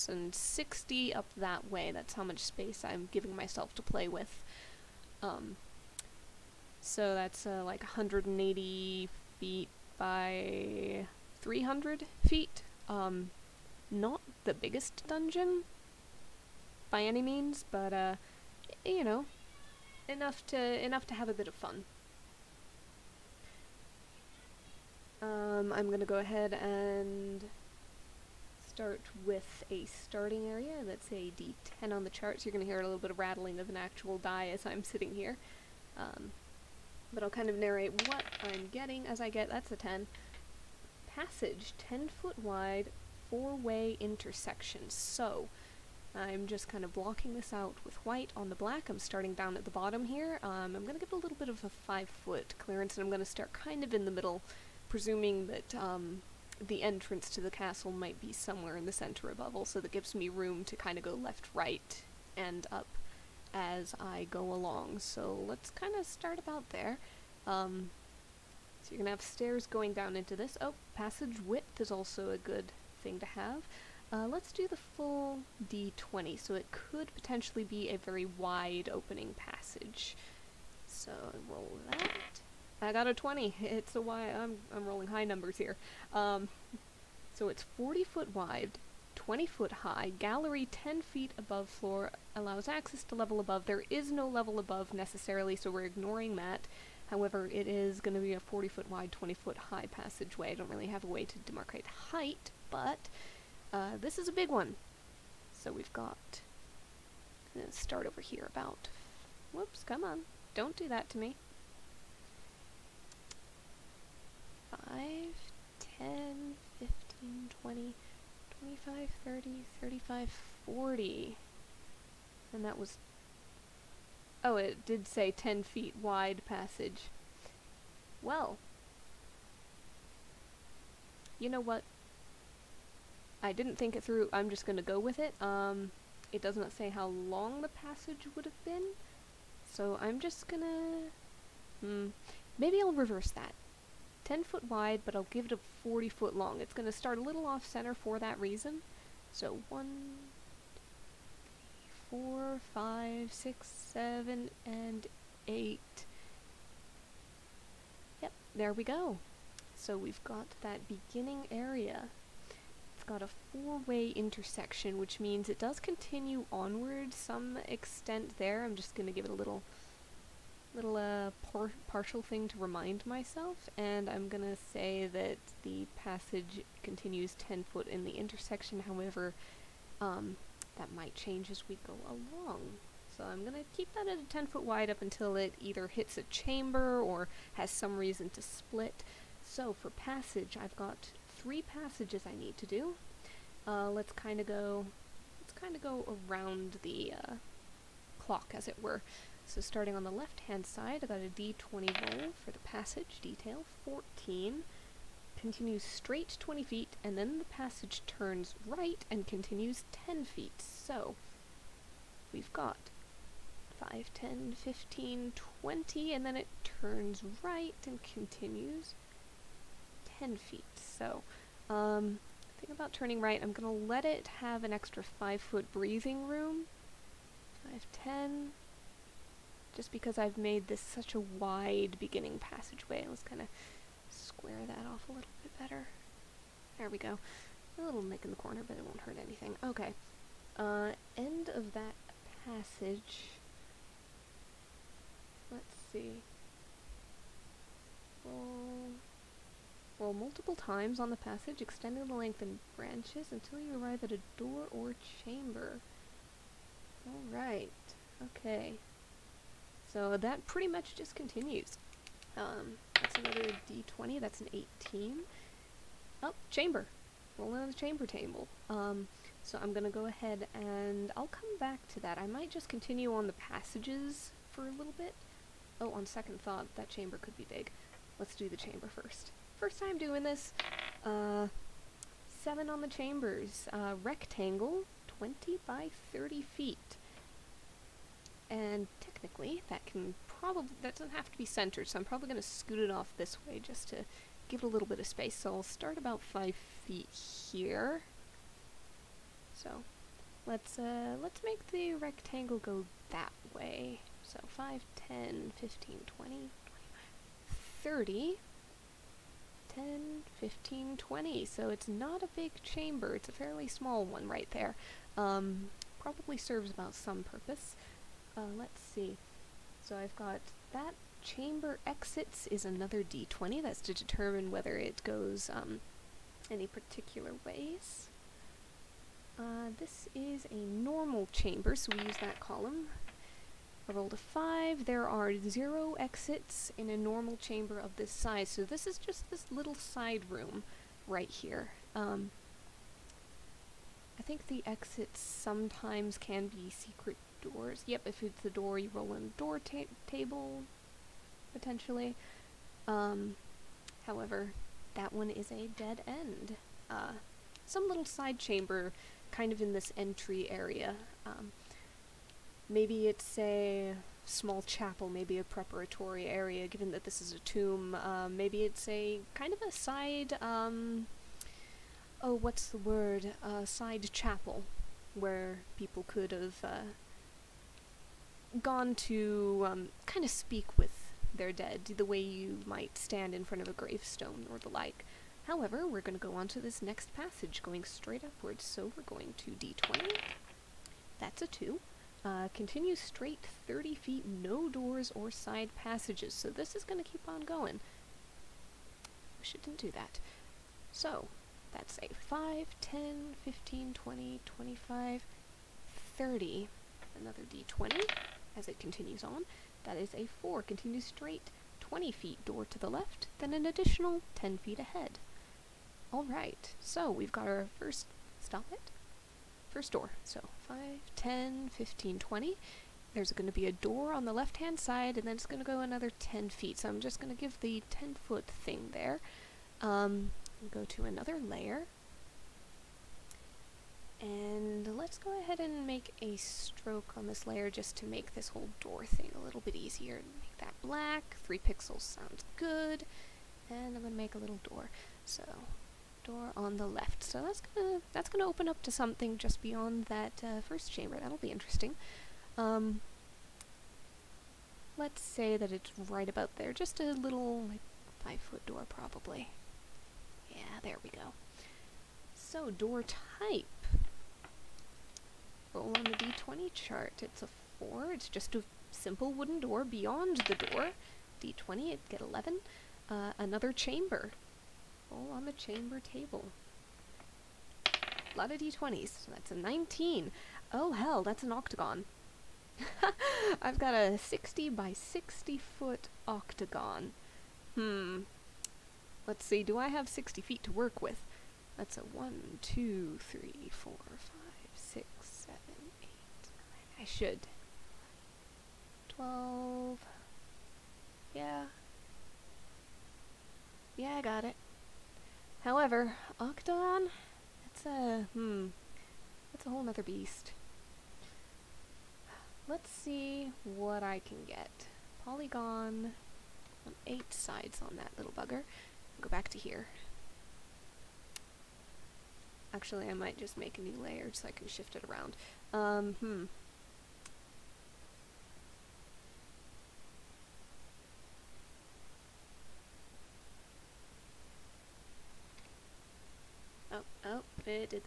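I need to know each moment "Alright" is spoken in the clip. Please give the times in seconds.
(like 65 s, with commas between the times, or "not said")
257 s, 416 s.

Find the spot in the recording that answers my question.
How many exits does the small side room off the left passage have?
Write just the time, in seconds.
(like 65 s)
334 s.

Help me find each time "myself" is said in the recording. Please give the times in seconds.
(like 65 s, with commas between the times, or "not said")
3 s, 173 s.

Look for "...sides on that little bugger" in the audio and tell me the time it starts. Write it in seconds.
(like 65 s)
517 s.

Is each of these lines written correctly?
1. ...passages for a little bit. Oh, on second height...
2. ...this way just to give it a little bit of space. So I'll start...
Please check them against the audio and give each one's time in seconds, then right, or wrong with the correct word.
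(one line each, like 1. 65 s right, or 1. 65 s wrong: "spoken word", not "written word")
1. 273 s wrong: "thought", not "height"
2. 293 s right.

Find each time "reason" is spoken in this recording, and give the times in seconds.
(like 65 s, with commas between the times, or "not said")
148 s, 187 s.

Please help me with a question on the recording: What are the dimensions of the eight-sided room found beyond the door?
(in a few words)
60 by 60 feet.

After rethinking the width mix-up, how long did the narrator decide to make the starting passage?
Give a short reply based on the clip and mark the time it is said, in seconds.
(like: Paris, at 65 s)
40 feet, at 145 s.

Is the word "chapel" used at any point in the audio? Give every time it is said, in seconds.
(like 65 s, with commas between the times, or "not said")
364 s, 374 s.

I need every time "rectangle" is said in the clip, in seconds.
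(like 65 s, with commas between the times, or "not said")
284 s, 301 s.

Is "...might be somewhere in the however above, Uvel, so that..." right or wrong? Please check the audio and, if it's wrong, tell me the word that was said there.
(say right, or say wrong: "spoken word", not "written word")
wrong: "center", not "however".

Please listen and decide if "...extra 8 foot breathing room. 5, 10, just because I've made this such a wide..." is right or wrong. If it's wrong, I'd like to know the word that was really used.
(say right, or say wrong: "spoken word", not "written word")
wrong: "5", not "8".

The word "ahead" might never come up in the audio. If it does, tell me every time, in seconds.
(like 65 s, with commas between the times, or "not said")
26 s, 270 s, 414 s, 435 s.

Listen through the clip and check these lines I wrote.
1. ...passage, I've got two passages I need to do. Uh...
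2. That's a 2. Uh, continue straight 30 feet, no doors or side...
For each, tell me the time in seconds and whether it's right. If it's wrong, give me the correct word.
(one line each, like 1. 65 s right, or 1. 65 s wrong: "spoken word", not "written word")
1. 189 s wrong: "three", not "two"
2. 391 s right.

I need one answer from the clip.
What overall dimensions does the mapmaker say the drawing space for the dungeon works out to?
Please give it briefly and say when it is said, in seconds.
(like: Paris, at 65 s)
180 feet by 300 feet, at 7 s.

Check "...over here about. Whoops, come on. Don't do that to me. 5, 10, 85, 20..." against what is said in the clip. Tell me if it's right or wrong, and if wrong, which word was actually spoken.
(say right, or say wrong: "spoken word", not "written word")
wrong: "15", not "85".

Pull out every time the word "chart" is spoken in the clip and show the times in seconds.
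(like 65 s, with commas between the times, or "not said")
32 s, 466 s.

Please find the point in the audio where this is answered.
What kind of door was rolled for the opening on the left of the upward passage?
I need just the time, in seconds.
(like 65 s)
468 s.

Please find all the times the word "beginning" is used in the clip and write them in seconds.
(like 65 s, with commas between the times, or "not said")
160 s, 231 s.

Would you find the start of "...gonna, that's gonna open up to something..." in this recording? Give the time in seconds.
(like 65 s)
447 s.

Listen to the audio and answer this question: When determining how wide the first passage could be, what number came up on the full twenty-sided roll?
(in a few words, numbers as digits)
20.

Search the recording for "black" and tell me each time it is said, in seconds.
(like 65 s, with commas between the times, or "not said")
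48 s, 440 s.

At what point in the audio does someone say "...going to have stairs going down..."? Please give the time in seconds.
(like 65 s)
68 s.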